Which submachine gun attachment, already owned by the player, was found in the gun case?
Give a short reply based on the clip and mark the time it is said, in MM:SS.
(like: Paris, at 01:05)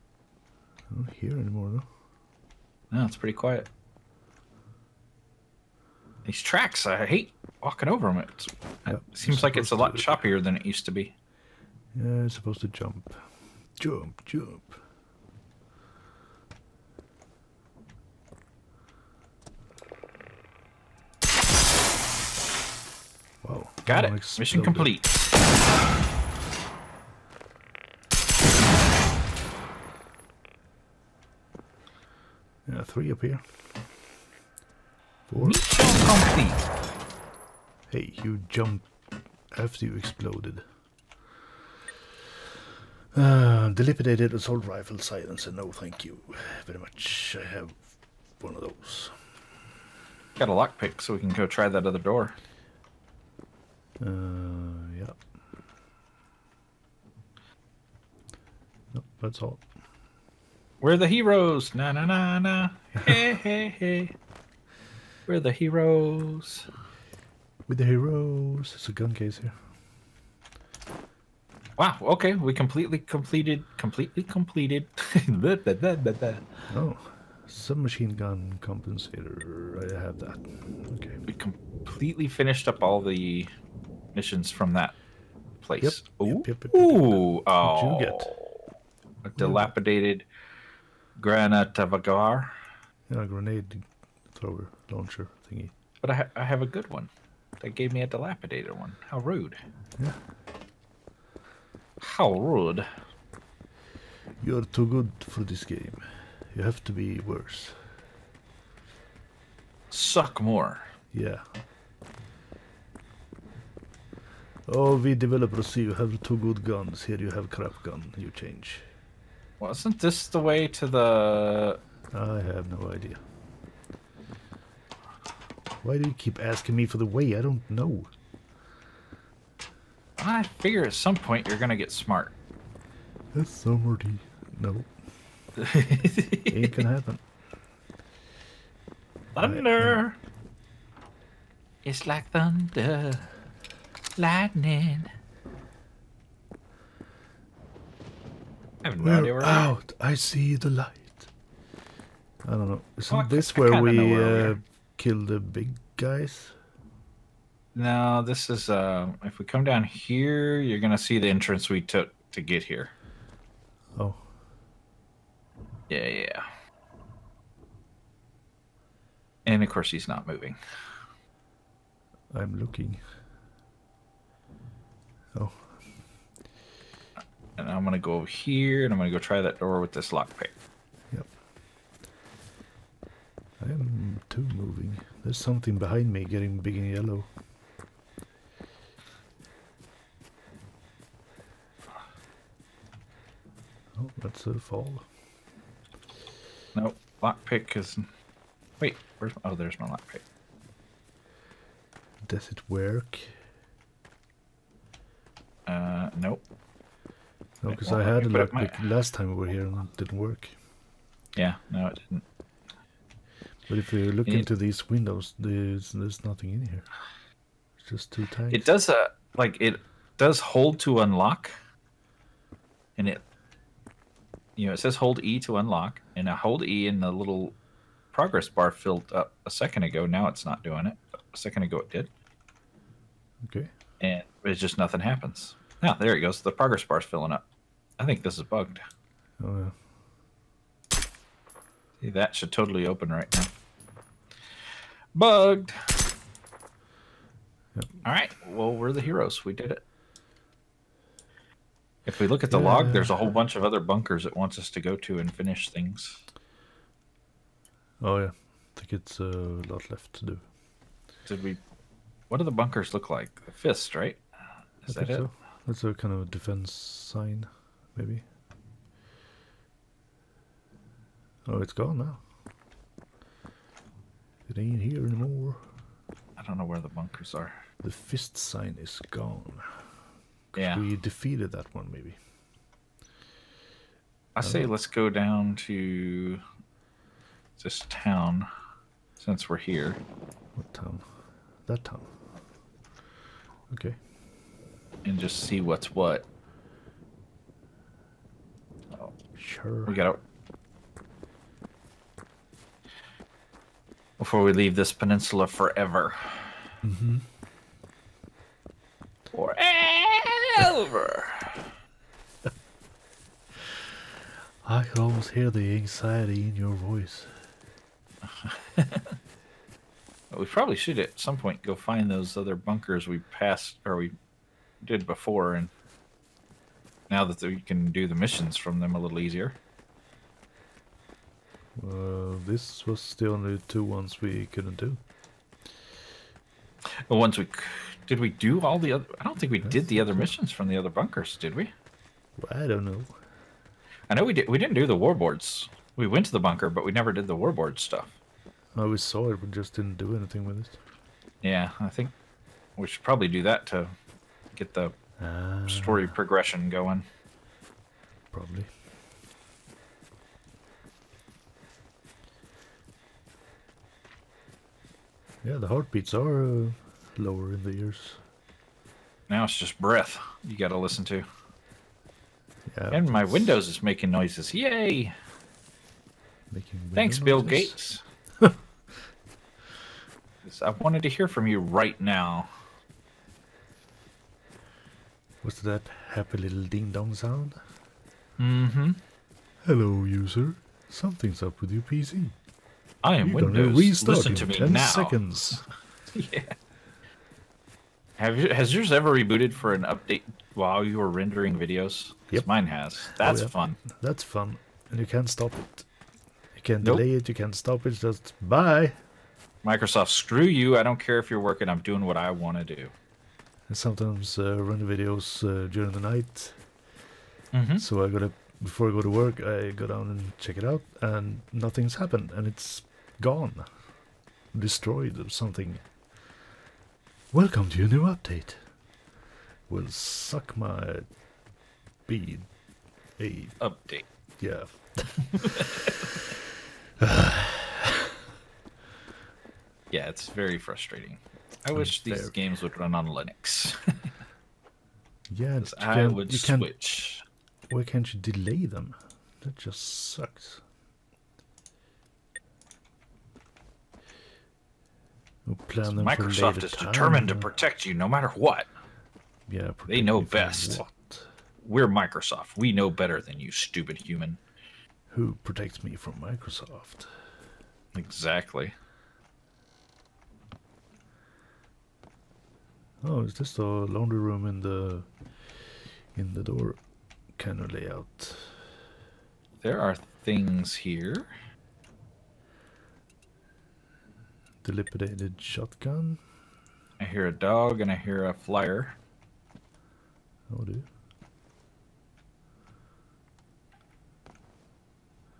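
submachine gun compensator, at 01:17.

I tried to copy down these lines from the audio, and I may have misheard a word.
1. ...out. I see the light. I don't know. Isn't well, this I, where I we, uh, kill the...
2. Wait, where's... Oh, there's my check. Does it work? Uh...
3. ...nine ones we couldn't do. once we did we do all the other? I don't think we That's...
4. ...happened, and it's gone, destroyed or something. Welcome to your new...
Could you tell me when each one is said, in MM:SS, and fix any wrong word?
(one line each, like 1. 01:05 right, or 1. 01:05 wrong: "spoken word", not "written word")
1. 02:29 right
2. 03:18 wrong: "lockpick", not "check"
3. 05:33 wrong: "two", not "nine"
4. 07:01 right.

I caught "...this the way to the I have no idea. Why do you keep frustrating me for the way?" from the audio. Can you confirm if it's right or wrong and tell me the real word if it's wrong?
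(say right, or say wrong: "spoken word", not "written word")
wrong: "asking", not "frustrating".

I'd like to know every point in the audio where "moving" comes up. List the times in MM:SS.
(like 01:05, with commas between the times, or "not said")
02:50, 03:04.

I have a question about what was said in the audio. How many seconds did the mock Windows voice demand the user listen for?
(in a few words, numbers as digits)
10.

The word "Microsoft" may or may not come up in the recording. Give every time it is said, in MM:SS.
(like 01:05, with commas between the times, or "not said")
06:49, 07:35, 07:41, 07:46.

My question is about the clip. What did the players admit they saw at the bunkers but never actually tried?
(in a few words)
warboards.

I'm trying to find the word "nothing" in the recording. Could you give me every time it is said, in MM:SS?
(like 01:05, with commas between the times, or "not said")
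03:36, 03:54, 07:01.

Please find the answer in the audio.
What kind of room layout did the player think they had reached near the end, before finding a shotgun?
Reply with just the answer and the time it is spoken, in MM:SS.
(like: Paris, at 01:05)
laundry room, at 07:53.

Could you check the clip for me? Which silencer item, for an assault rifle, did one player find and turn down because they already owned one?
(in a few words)
dilapidated assault rifle silencer.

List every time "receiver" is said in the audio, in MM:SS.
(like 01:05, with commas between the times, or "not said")
not said.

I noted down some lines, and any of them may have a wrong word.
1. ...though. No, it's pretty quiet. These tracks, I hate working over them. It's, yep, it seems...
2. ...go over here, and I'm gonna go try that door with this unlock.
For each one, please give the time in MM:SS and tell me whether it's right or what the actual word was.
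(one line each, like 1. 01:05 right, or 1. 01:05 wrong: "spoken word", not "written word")
1. 00:01 wrong: "walking", not "working"
2. 02:57 wrong: "lockpick", not "unlock".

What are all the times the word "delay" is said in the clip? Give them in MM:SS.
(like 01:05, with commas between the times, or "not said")
06:46, 07:28.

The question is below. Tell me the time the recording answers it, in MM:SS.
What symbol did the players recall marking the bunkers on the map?
04:23.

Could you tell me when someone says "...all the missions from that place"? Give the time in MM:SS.
01:22.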